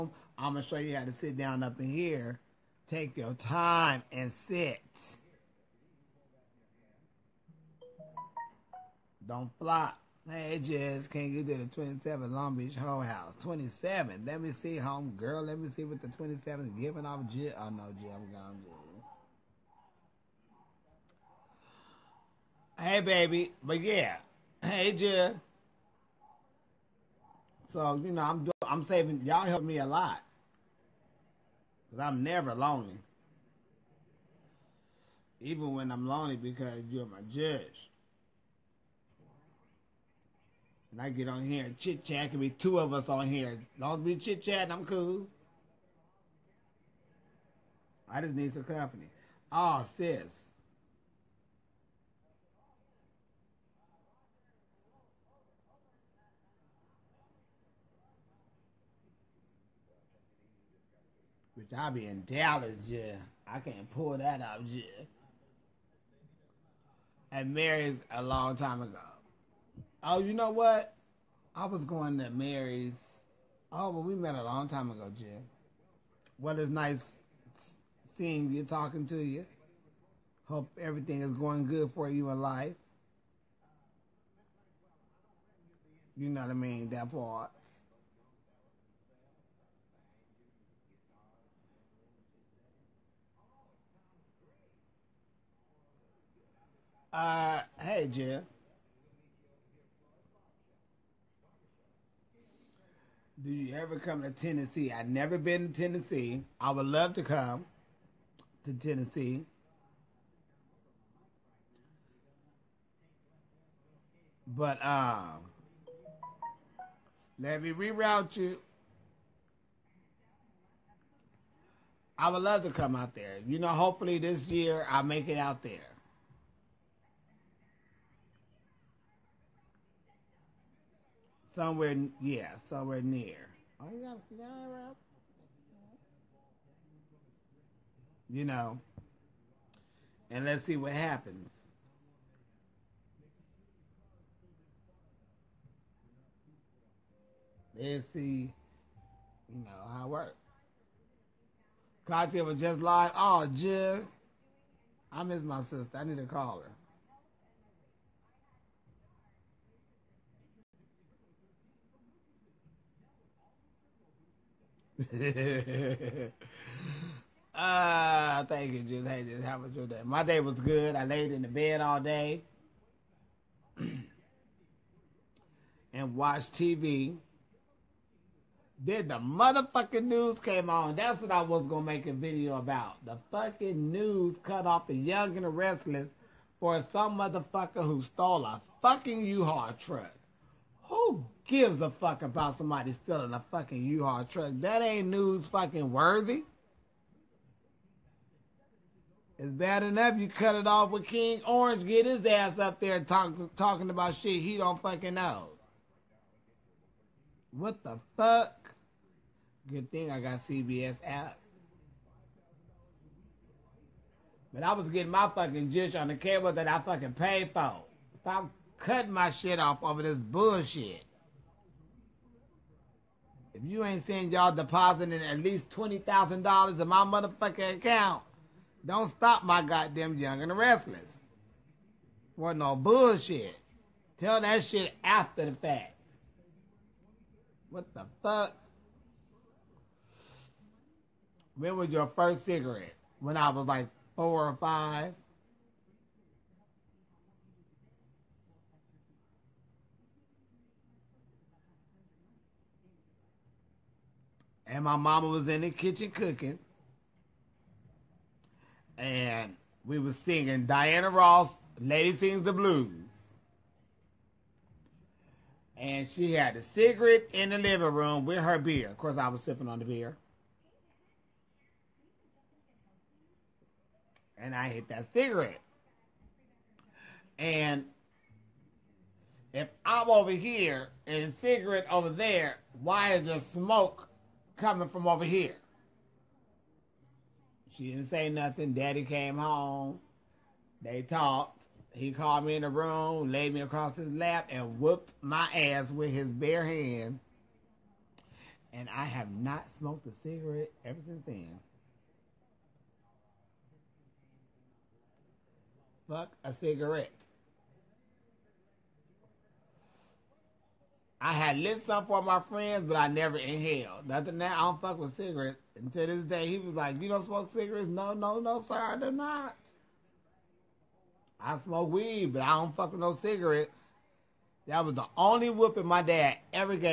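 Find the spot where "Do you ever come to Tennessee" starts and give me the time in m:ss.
1:43.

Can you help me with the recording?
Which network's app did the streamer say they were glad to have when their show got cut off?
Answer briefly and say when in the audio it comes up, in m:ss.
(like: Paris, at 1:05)
CBS, at 3:30.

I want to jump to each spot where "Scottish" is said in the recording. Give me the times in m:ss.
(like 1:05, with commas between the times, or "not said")
not said.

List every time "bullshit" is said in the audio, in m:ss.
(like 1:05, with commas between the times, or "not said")
3:40, 3:52.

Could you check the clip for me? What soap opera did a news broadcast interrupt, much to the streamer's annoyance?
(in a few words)
The Young and the Restless.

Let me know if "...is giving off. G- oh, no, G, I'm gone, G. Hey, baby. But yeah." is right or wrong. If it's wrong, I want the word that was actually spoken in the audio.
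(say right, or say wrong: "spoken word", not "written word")
right.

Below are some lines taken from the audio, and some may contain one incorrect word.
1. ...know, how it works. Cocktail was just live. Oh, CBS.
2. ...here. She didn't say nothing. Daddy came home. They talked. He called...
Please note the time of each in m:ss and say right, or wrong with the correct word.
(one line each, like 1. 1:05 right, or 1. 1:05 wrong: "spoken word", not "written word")
1. 2:29 wrong: "Jill", not "CBS"
2. 4:45 right.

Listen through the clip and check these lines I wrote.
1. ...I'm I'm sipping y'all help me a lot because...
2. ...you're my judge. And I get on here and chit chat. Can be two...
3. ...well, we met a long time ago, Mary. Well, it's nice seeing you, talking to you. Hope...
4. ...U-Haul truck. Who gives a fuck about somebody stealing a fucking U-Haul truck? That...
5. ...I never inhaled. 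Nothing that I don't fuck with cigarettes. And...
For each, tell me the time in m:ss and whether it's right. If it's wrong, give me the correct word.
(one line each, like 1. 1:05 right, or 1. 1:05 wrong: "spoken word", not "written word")
1. 0:28 wrong: "saving", not "sipping"
2. 0:36 right
3. 1:13 wrong: "Jill", not "Mary"
4. 3:09 right
5. 5:12 right.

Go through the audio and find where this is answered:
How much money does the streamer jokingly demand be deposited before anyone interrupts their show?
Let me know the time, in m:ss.
3:45.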